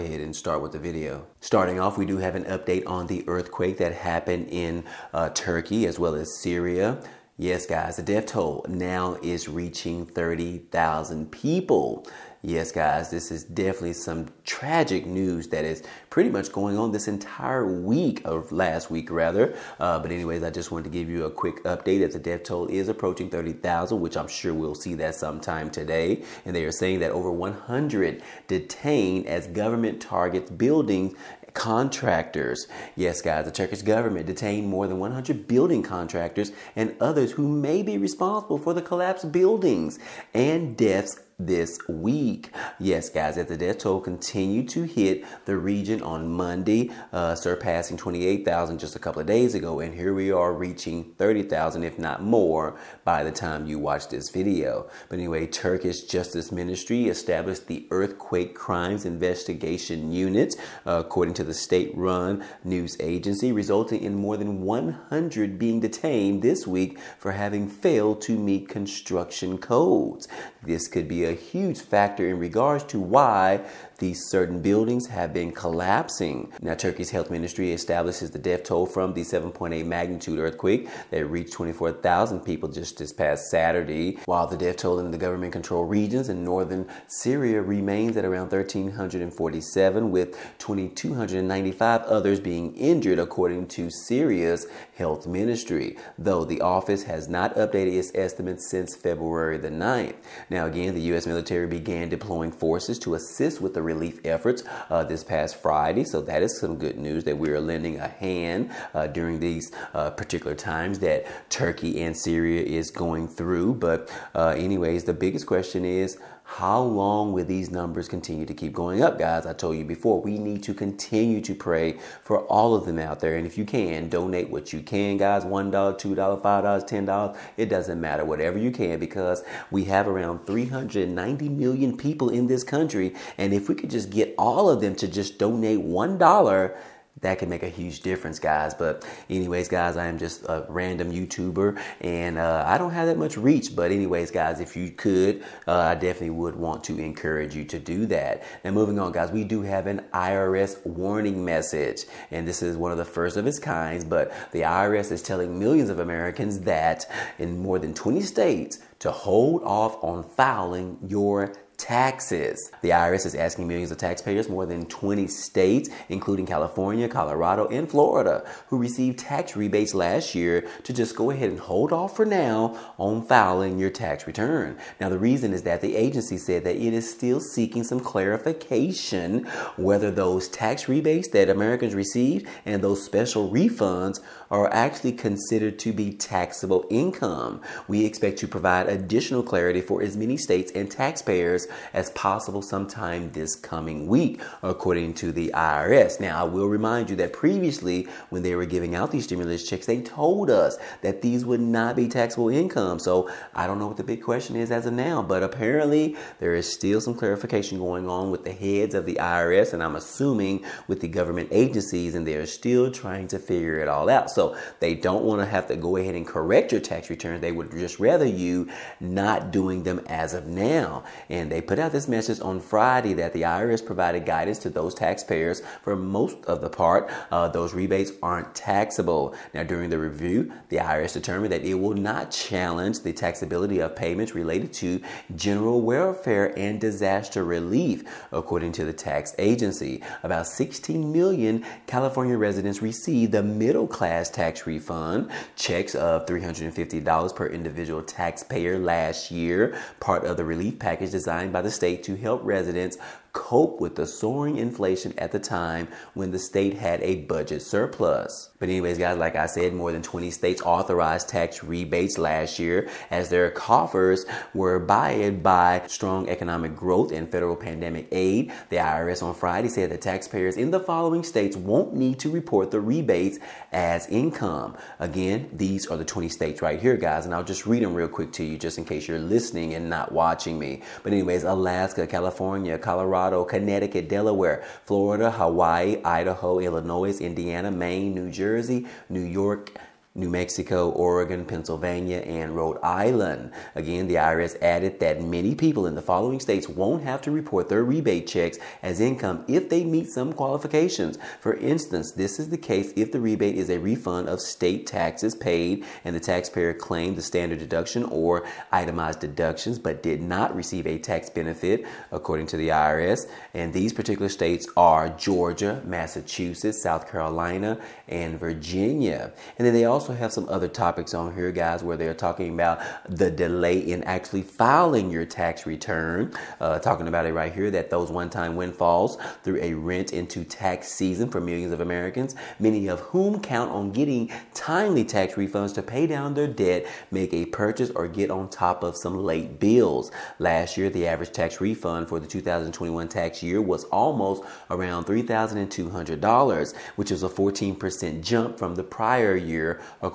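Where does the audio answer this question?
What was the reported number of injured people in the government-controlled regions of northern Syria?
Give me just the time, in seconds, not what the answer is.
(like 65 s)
90 s.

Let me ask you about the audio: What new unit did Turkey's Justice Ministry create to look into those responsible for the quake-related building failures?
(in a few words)
Earthquake Crimes Investigation Unit.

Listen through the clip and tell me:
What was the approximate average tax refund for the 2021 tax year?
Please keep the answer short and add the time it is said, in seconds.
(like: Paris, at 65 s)
$3,200, at 345 s.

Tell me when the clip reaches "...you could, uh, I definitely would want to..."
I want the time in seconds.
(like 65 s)
144 s.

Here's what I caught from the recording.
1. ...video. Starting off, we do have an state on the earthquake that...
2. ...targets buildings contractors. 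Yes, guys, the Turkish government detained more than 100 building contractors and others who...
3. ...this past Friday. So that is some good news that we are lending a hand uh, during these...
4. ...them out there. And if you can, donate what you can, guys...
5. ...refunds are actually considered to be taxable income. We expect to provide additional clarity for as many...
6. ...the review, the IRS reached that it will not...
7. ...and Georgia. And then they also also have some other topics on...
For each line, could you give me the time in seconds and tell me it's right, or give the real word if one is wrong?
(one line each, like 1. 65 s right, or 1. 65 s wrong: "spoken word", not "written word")
1. 0 s wrong: "update", not "state"
2. 30 s right
3. 105 s right
4. 122 s right
5. 183 s right
6. 229 s wrong: "determined", not "reached"
7. 318 s wrong: "Virginia", not "Georgia".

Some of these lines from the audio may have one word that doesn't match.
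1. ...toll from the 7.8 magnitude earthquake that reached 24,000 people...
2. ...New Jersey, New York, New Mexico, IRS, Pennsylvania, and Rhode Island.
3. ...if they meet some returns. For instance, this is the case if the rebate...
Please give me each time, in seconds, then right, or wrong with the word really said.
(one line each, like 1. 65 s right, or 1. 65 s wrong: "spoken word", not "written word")
1. 78 s right
2. 288 s wrong: "Oregon", not "IRS"
3. 299 s wrong: "qualifications", not "returns".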